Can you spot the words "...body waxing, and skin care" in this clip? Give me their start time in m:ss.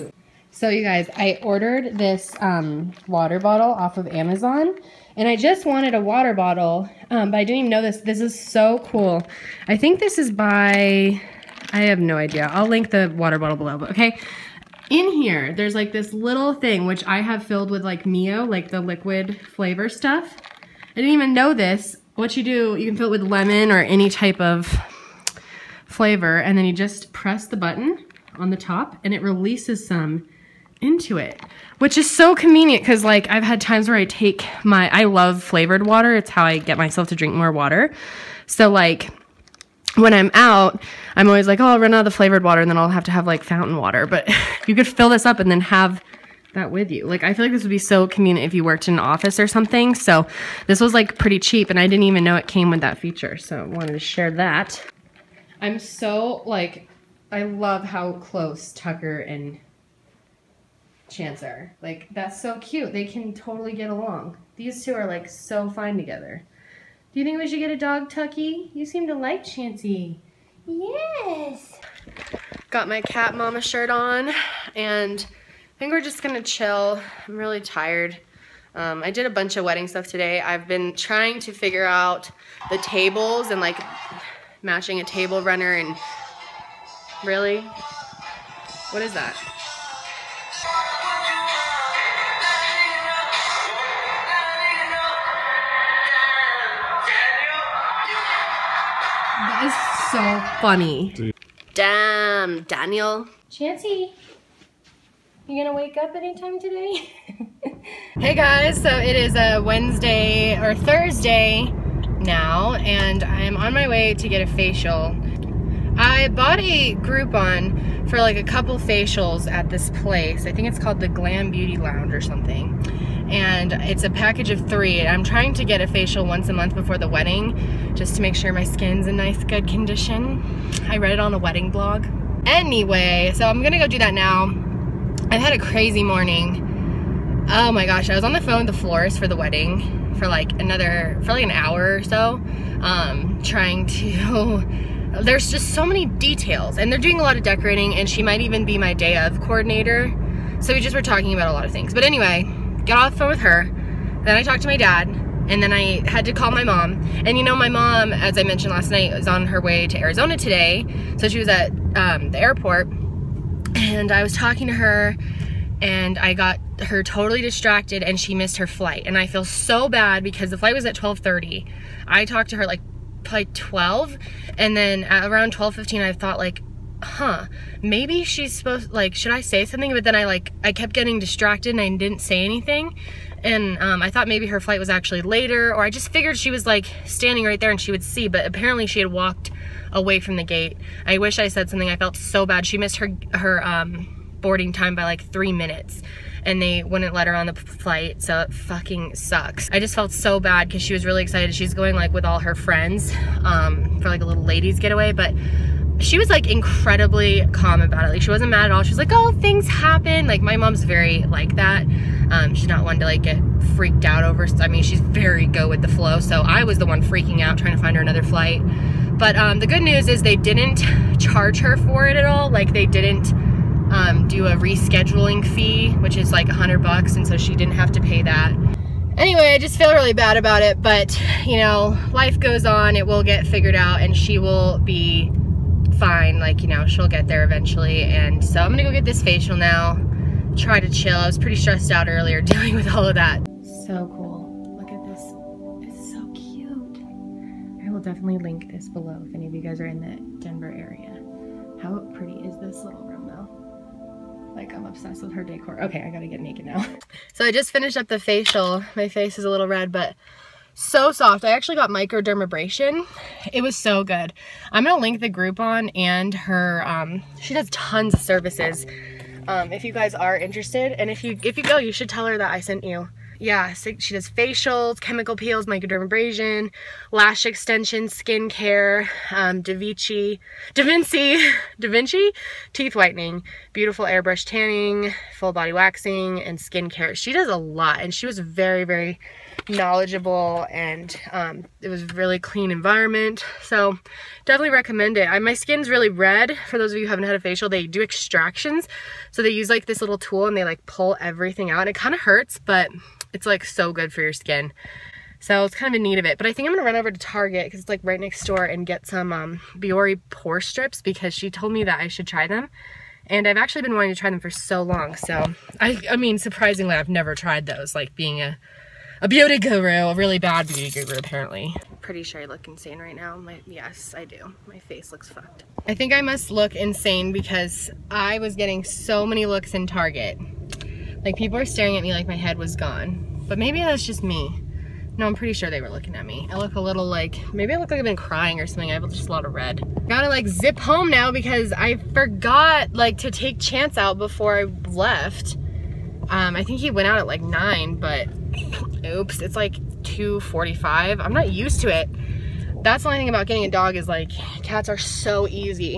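4:45.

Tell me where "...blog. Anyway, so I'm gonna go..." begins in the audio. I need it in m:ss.
2:11.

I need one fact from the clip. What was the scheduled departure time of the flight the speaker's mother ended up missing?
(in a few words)
12:30.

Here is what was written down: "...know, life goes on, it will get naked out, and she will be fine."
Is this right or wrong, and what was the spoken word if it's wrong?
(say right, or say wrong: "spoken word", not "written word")
wrong: "figured", not "naked".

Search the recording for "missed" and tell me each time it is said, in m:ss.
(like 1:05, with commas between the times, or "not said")
2:48, 3:12.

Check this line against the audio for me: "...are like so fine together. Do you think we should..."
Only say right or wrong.
right.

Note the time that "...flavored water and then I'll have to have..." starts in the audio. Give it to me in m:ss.
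0:42.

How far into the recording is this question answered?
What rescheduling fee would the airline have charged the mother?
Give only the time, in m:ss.
3:46.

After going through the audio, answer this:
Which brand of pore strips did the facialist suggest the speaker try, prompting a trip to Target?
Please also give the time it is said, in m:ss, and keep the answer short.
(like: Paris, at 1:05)
Biore, at 5:09.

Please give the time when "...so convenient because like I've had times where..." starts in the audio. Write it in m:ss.
0:32.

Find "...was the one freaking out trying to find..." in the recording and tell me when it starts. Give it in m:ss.
3:36.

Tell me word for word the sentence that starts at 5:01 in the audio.
And it kind of hurts, but it's like so good for your skin.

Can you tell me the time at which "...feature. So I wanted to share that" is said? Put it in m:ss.
0:52.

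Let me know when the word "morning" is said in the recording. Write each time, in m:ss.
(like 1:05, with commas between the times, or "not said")
2:16.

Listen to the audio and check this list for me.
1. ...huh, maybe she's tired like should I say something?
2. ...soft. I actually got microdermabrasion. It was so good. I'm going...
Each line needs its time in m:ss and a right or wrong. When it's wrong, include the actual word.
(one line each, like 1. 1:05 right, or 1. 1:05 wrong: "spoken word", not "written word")
1. 2:57 wrong: "supposed", not "tired"
2. 4:21 right.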